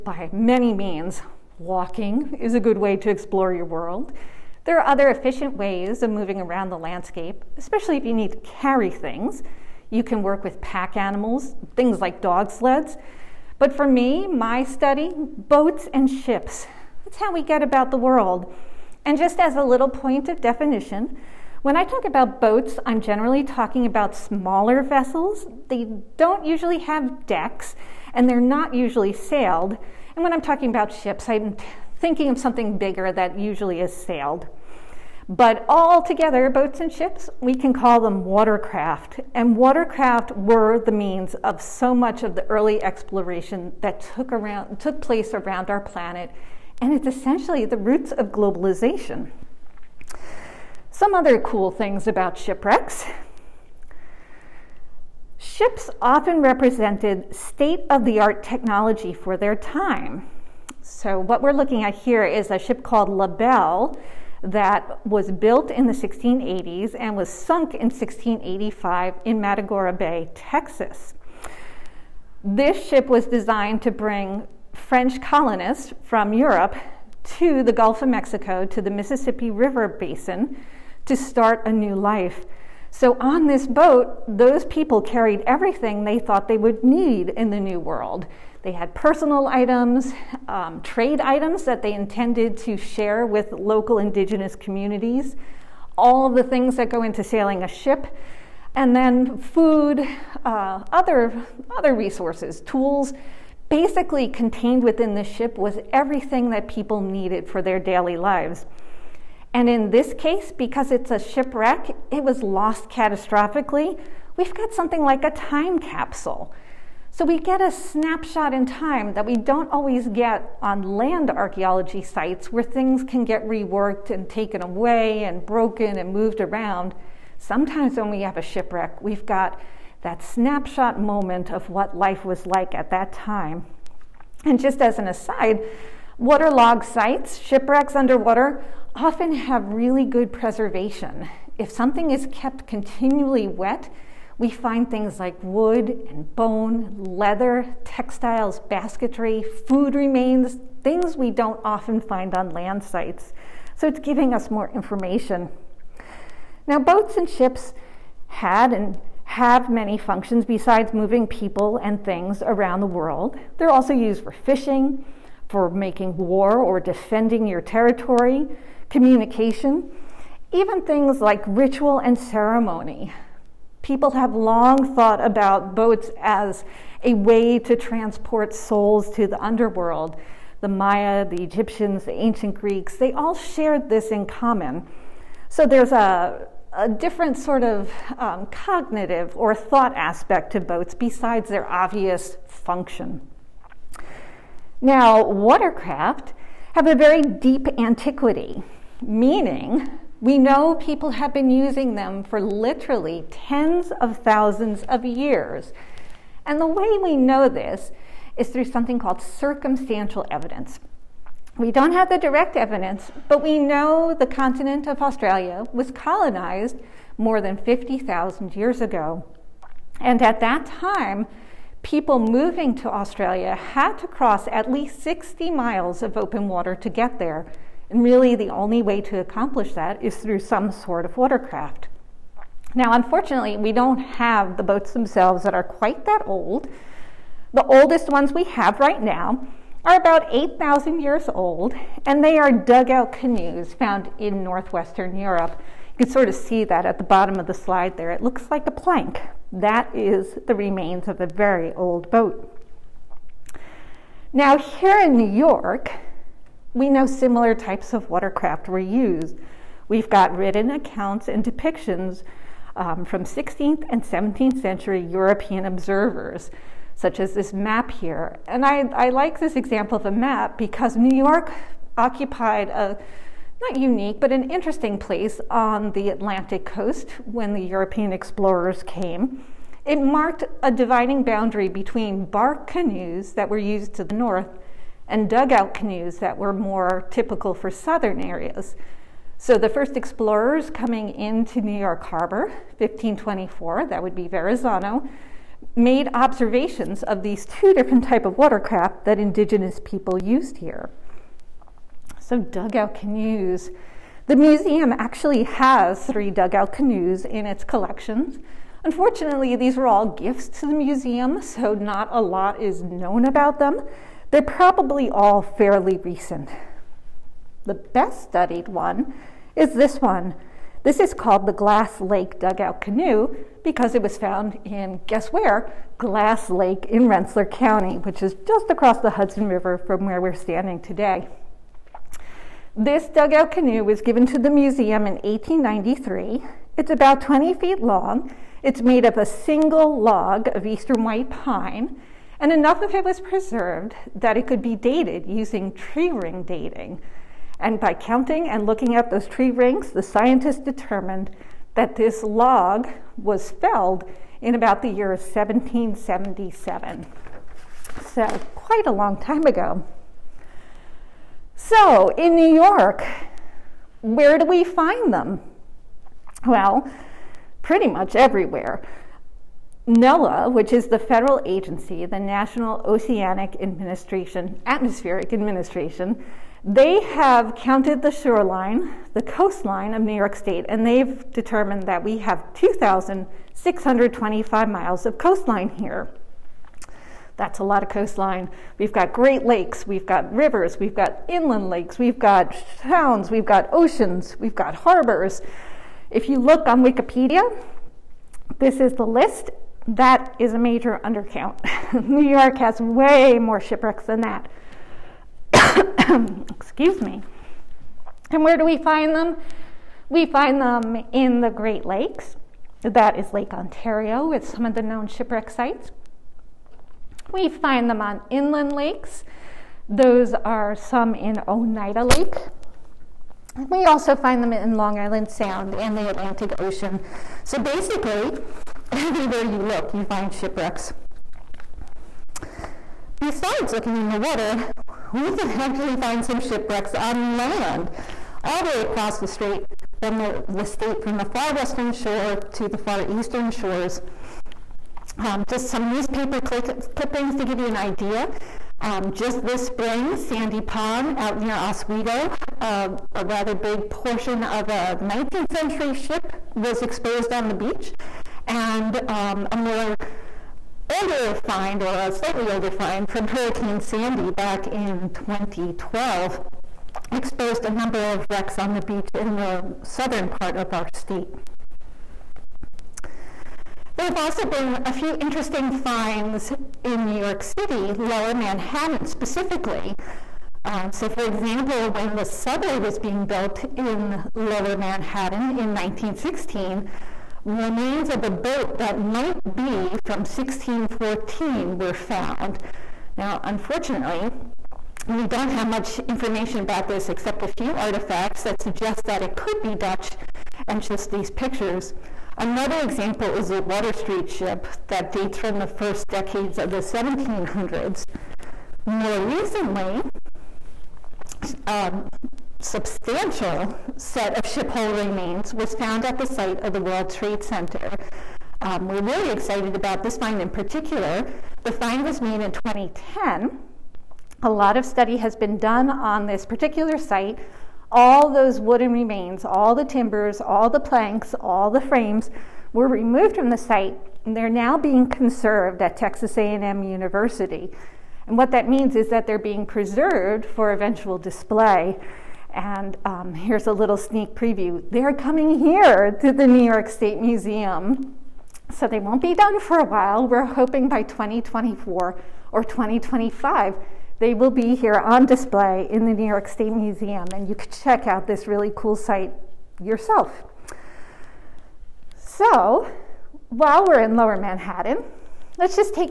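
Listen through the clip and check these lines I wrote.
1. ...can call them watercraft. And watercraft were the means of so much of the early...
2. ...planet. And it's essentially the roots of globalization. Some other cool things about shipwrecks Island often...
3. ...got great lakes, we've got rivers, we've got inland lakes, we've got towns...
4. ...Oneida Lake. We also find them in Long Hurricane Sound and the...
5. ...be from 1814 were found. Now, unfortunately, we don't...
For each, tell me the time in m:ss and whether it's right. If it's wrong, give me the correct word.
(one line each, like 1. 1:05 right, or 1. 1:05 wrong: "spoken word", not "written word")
1. 0:37 right
2. 0:45 wrong: "Ships", not "Island"
3. 6:28 right
4. 7:01 wrong: "Island", not "Hurricane"
5. 8:09 wrong: "1614", not "1814".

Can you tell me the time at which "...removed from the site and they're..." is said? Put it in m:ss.
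8:52.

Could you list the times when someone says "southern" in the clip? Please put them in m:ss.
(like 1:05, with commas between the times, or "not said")
4:47, 7:49.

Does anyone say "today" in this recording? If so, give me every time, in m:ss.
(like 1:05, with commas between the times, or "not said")
5:30.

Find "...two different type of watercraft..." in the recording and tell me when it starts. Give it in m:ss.
4:57.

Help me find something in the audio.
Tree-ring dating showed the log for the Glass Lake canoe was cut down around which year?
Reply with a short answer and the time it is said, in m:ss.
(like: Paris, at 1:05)
1777, at 5:55.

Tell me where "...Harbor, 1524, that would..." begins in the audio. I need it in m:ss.
4:52.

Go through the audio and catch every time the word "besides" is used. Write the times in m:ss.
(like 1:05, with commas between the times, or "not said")
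2:40, 3:10, 7:13.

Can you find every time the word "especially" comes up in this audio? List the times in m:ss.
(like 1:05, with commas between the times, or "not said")
0:07.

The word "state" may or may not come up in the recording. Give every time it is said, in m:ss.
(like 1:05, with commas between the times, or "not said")
0:57, 6:20, 7:20, 7:50, 9:06, 9:16.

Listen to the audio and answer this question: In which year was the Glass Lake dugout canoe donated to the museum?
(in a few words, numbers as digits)
1893.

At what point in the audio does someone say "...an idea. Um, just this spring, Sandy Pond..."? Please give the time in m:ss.
7:27.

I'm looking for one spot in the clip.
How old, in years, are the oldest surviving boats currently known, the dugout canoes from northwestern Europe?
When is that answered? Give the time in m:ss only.
4:00.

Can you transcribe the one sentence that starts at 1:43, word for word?
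Basically, contained within the ship was everything that people needed for their daily lives.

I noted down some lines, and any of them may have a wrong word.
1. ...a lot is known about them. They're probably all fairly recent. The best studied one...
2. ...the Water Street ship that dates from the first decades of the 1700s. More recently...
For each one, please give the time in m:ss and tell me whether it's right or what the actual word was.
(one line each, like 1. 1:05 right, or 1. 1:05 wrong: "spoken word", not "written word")
1. 5:12 right
2. 8:23 right.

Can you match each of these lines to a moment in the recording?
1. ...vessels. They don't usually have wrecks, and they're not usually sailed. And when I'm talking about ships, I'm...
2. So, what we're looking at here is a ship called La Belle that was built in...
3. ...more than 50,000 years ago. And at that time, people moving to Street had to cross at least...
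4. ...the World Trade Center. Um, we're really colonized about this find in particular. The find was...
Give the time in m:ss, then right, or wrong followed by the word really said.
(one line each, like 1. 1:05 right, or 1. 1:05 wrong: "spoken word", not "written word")
1. 0:24 wrong: "decks", not "wrecks"
2. 1:00 right
3. 3:37 wrong: "Australia", not "Street"
4. 8:36 wrong: "excited", not "colonized".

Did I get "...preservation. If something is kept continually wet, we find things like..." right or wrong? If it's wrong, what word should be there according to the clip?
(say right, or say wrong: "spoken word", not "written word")
right.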